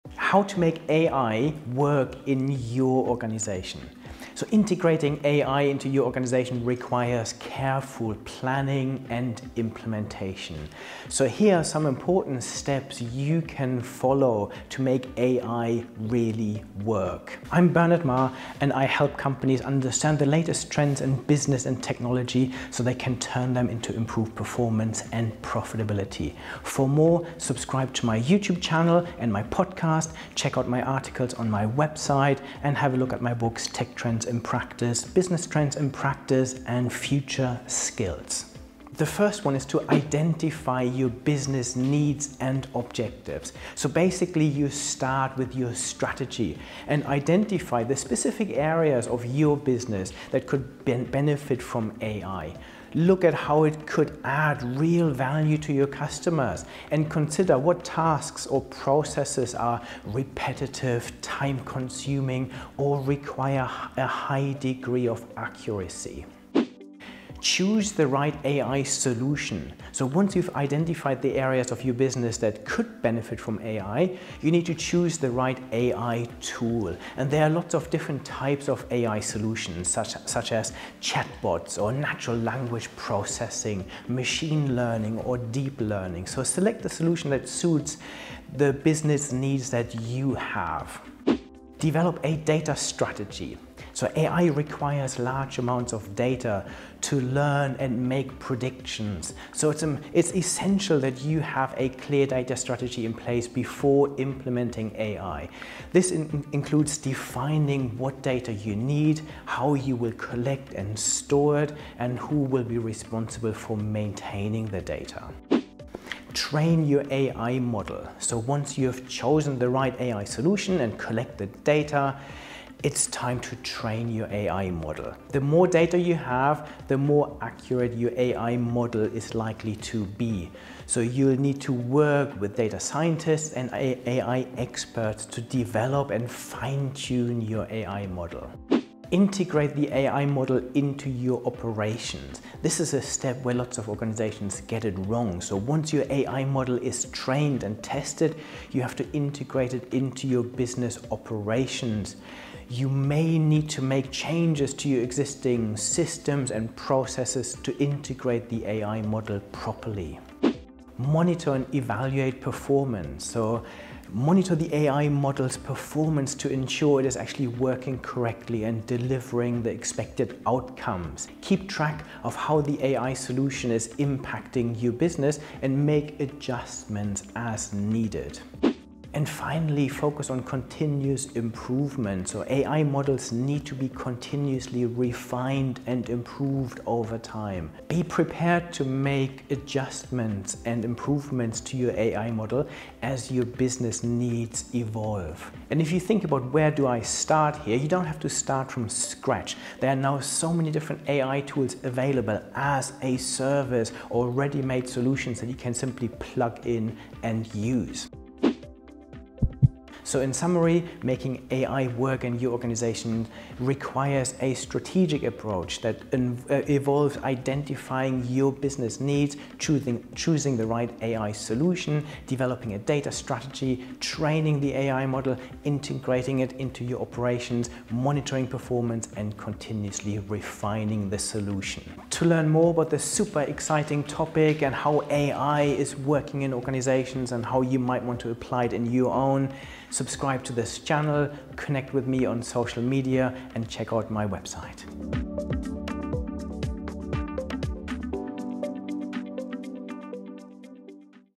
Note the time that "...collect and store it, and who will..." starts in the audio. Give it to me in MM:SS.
01:50.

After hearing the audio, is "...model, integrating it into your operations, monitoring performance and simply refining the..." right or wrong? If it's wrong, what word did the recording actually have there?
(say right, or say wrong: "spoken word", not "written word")
wrong: "continuously", not "simply".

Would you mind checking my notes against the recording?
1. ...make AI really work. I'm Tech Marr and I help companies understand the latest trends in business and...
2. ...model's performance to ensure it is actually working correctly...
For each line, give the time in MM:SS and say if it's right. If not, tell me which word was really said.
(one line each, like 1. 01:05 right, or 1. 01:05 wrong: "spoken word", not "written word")
1. 00:14 wrong: "Bernard", not "Tech"
2. 02:45 right.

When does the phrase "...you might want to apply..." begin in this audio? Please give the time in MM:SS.
03:57.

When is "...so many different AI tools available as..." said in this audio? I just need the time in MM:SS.
03:20.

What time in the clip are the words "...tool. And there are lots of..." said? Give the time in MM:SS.
01:16.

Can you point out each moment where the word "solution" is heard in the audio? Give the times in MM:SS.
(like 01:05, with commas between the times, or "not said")
01:08, 01:19, 01:26, 02:00, 02:53, 03:24, 03:41, 03:51.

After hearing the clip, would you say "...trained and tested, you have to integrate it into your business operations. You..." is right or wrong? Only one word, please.
right.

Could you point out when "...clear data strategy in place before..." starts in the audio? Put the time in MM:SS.
01:41.